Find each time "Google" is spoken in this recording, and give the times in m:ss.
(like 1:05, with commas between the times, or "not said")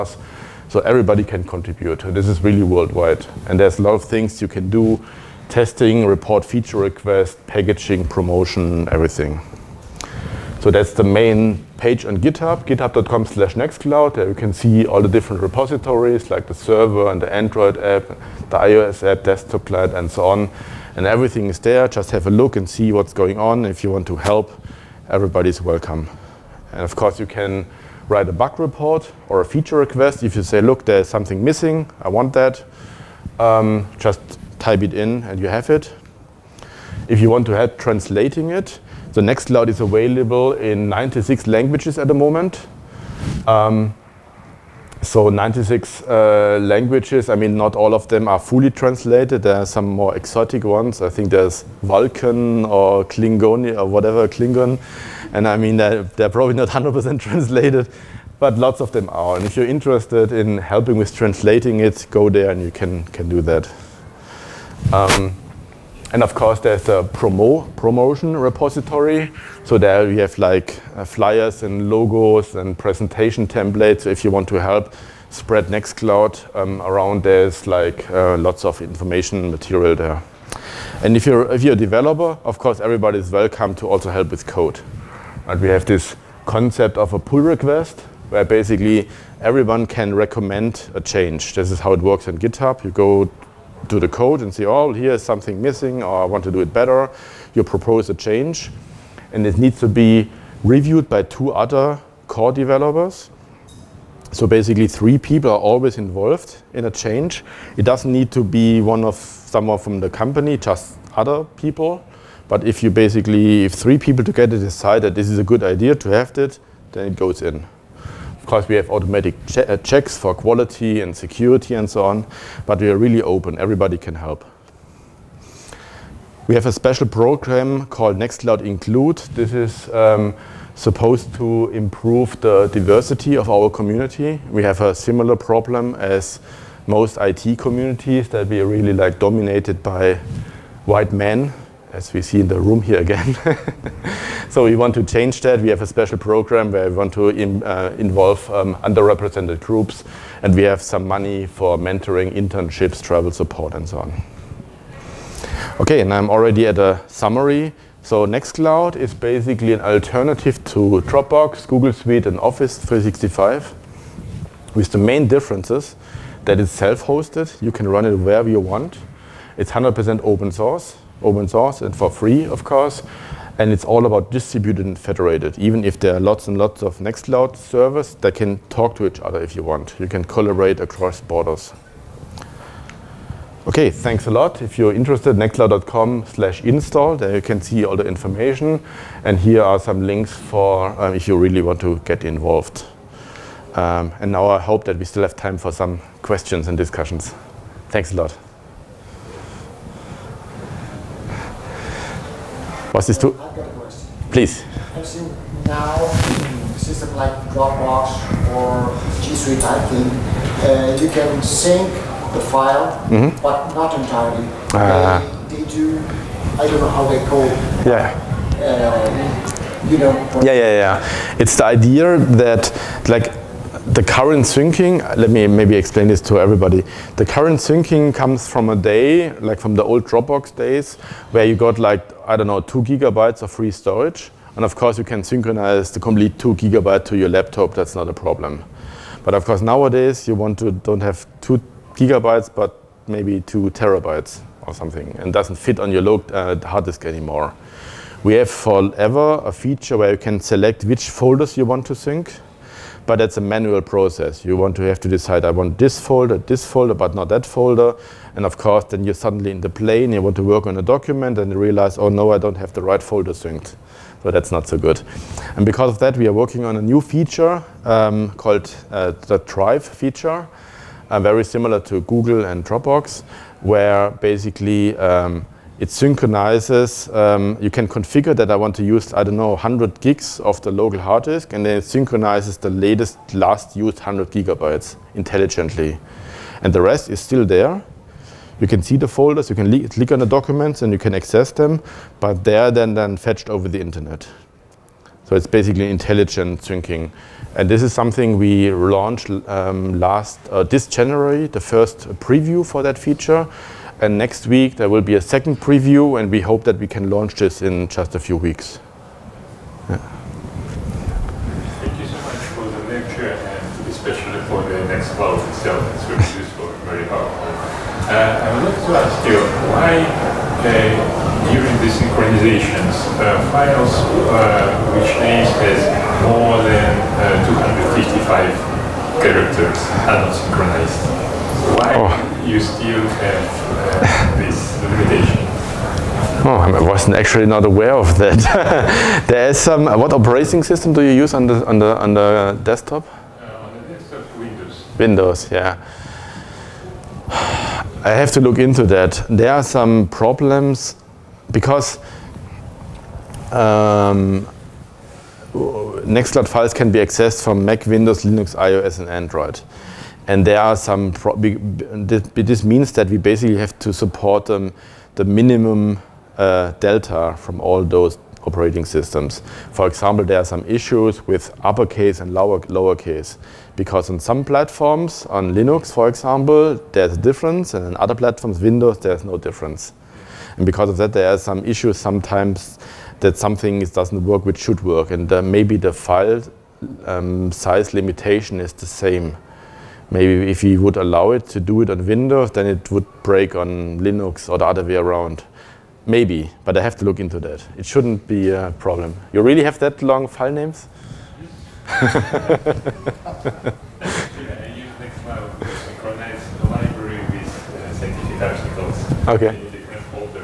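2:41, 4:32.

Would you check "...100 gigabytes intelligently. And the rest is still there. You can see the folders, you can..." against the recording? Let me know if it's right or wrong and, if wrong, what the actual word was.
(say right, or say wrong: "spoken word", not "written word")
right.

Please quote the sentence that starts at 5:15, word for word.
It's very useful and very helpful.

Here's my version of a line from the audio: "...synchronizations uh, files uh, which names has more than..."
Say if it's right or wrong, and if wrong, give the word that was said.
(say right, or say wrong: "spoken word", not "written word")
right.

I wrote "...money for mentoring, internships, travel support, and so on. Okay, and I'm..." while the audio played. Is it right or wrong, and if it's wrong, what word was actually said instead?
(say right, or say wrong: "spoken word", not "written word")
right.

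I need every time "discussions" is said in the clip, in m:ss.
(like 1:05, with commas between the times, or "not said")
3:16.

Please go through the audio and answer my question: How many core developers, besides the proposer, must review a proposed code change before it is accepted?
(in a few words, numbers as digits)
2.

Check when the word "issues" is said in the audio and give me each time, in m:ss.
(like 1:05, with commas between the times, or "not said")
6:10, 6:21.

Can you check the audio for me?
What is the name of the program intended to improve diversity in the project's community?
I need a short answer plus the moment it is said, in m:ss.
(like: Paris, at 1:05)
Nextcloud Include, at 2:08.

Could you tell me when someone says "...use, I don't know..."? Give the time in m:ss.
4:38.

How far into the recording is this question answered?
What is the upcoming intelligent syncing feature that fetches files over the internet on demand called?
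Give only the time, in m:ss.
4:29.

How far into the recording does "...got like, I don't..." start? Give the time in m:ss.
3:51.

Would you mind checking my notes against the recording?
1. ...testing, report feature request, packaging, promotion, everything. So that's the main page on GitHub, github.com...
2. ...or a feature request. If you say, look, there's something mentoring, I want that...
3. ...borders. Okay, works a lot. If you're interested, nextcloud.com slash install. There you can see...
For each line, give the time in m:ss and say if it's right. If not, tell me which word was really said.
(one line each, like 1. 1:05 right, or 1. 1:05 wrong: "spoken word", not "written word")
1. 0:05 right
2. 0:29 wrong: "missing", not "mentoring"
3. 3:01 wrong: "thanks", not "works".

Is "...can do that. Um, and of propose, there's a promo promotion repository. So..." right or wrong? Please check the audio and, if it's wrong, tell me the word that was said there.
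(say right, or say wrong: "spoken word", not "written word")
wrong: "course", not "propose".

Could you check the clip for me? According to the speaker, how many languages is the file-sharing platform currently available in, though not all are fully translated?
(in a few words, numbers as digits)
96.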